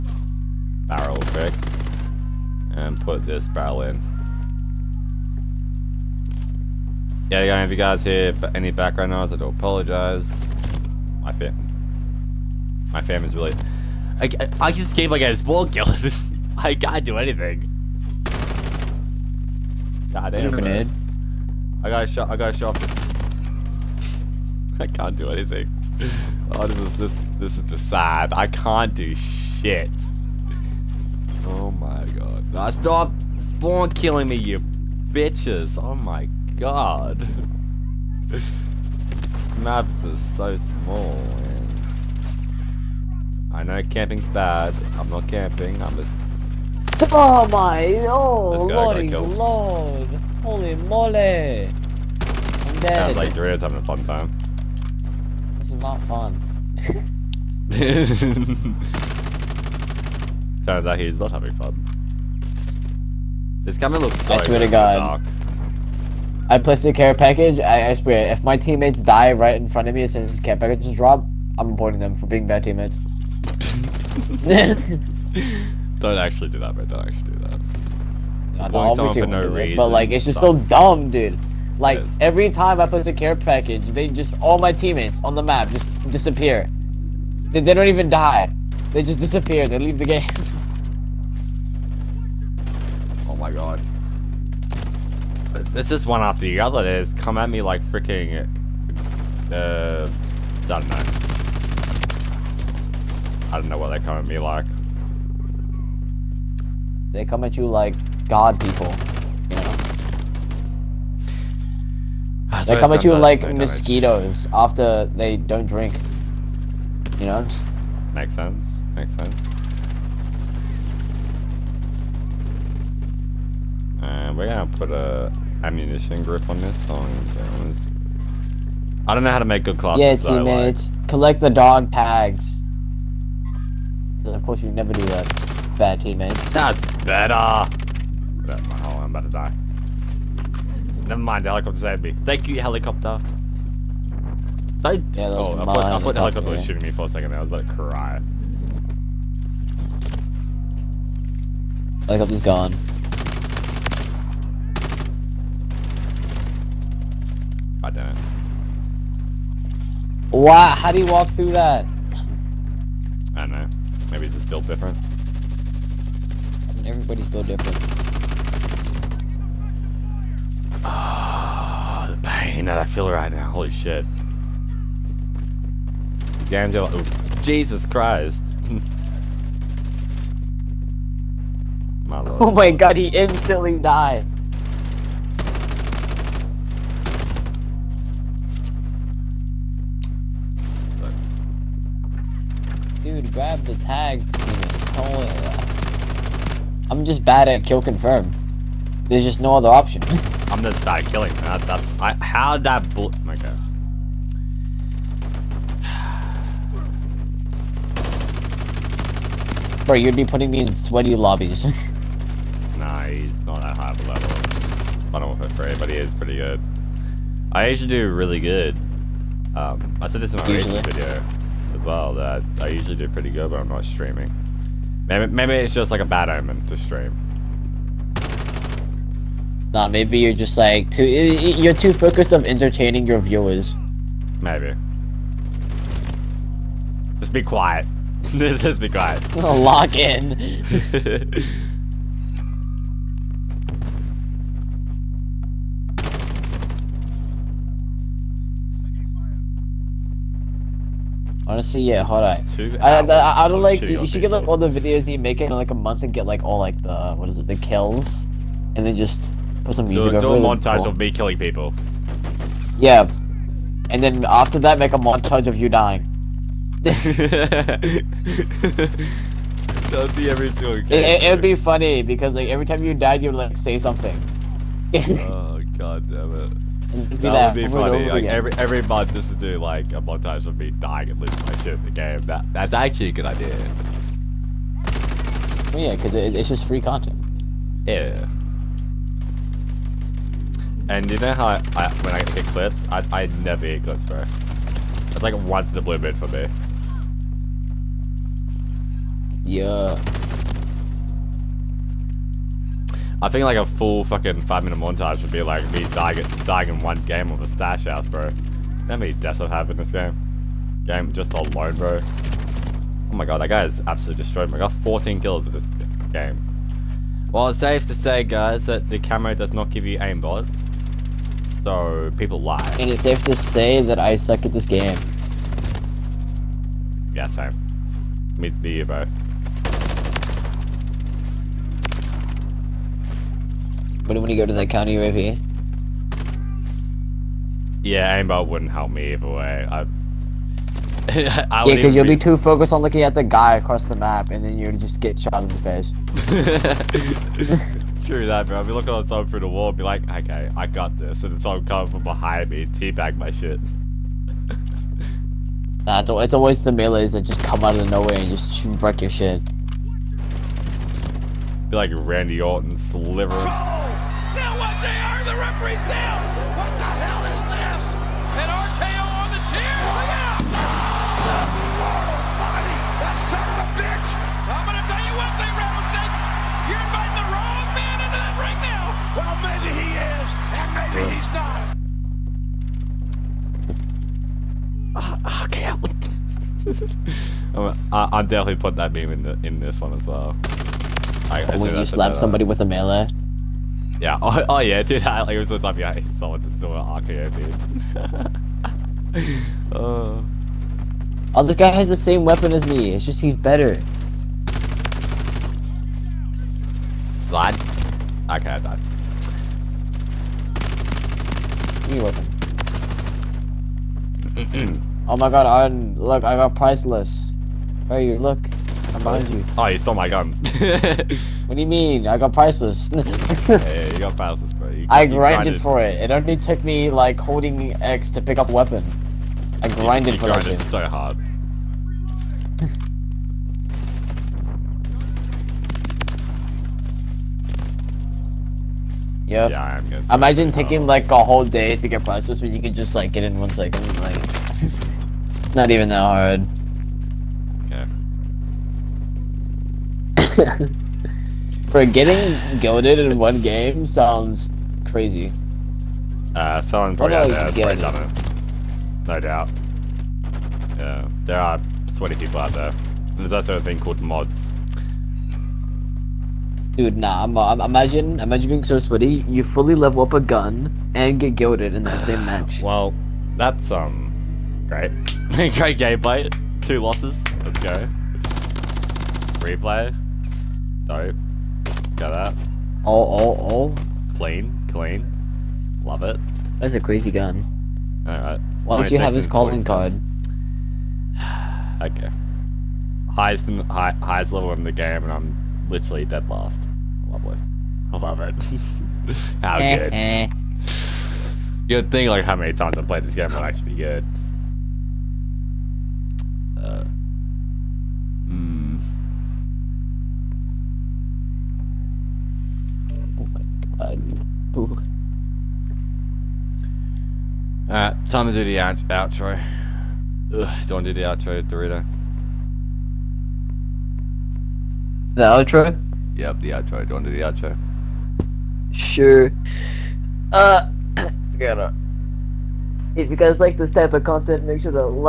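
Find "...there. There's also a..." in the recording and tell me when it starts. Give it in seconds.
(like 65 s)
462 s.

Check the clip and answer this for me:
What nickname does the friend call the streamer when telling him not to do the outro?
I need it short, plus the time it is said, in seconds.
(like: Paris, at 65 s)
Dorito, at 521 s.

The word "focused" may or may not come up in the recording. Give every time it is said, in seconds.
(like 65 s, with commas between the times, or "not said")
231 s, 342 s.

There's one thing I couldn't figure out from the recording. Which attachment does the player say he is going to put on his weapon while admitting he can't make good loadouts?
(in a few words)
Ammunition grip.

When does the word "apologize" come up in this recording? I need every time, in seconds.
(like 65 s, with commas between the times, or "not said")
9 s.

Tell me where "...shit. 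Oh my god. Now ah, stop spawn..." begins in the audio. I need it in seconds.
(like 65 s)
29 s.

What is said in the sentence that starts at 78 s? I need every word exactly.
No, the obviously no do but like, it's just sucks.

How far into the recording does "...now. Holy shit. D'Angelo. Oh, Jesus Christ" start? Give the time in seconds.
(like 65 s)
173 s.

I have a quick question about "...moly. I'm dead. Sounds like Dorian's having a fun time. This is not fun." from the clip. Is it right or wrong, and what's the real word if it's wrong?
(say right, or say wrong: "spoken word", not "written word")
right.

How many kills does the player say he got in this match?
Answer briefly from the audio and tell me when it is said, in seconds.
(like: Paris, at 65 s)
14, at 314 s.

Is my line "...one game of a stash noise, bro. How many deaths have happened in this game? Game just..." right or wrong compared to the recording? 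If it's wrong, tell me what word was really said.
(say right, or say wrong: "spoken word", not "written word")
wrong: "house", not "noise".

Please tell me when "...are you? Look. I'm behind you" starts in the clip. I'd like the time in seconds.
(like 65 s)
417 s.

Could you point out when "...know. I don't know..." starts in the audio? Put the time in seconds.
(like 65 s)
100 s.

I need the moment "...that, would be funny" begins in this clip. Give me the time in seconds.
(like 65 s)
277 s.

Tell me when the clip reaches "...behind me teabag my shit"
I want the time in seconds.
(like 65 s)
352 s.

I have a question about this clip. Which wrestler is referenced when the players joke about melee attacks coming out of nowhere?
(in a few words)
Randy Orton.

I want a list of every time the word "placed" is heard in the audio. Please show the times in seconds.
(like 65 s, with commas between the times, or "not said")
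66 s.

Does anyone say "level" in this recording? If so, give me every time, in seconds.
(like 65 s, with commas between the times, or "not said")
214 s, 469 s, 494 s.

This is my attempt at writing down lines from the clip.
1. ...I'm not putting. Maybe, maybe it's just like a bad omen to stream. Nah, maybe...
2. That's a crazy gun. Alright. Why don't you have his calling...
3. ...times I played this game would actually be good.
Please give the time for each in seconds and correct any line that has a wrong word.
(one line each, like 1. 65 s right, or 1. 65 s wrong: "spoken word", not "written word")
1. 223 s wrong: "streaming", not "putting"
2. 486 s right
3. 502 s right.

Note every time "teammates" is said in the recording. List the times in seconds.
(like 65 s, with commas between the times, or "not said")
68 s, 72 s, 84 s, 130 s, 136 s.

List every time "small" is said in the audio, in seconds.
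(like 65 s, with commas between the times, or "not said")
15 s, 40 s.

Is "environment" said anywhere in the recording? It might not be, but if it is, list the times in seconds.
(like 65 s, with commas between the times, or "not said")
not said.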